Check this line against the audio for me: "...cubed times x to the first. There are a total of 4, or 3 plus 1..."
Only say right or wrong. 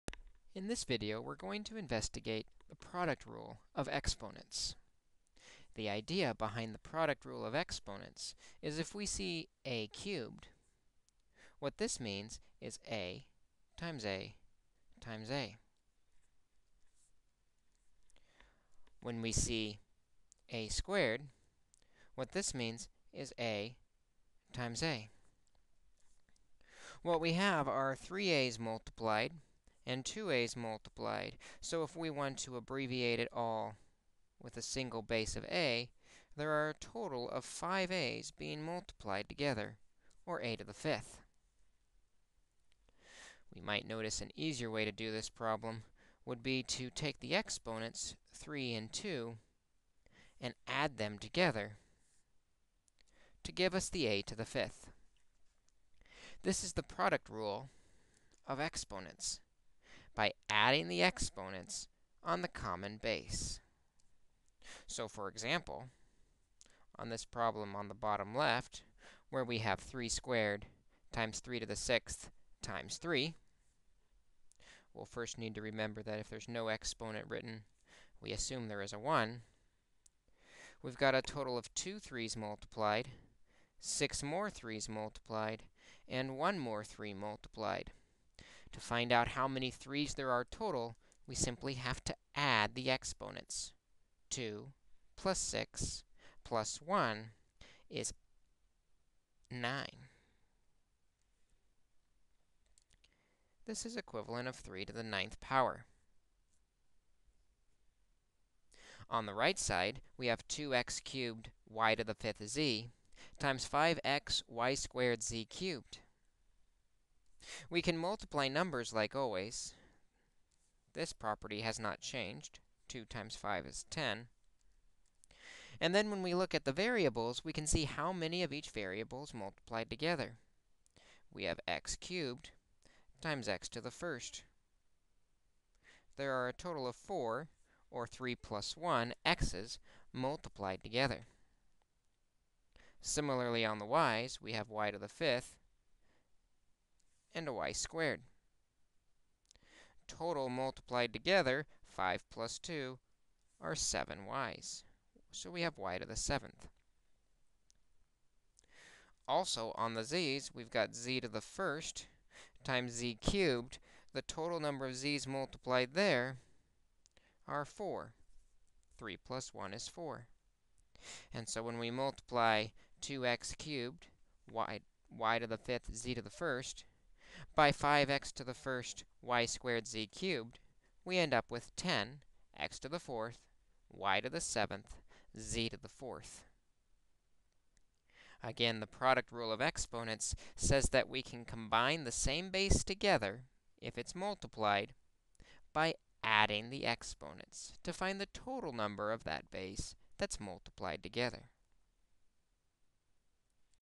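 right.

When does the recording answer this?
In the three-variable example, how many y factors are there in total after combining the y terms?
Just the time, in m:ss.
2:33.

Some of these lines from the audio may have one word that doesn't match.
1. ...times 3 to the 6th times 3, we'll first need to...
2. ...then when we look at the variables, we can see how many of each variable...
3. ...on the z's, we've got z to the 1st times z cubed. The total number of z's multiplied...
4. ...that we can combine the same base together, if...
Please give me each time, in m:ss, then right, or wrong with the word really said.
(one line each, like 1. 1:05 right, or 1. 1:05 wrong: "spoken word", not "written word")
1. 1:11 right
2. 2:05 right
3. 2:39 right
4. 3:10 right.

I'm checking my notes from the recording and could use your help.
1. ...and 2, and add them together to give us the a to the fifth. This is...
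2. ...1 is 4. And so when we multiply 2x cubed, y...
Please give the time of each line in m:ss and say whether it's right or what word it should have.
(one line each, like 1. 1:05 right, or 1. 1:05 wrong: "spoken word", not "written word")
1. 0:48 right
2. 2:49 right.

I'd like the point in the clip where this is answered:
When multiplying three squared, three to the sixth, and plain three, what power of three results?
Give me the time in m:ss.
1:44.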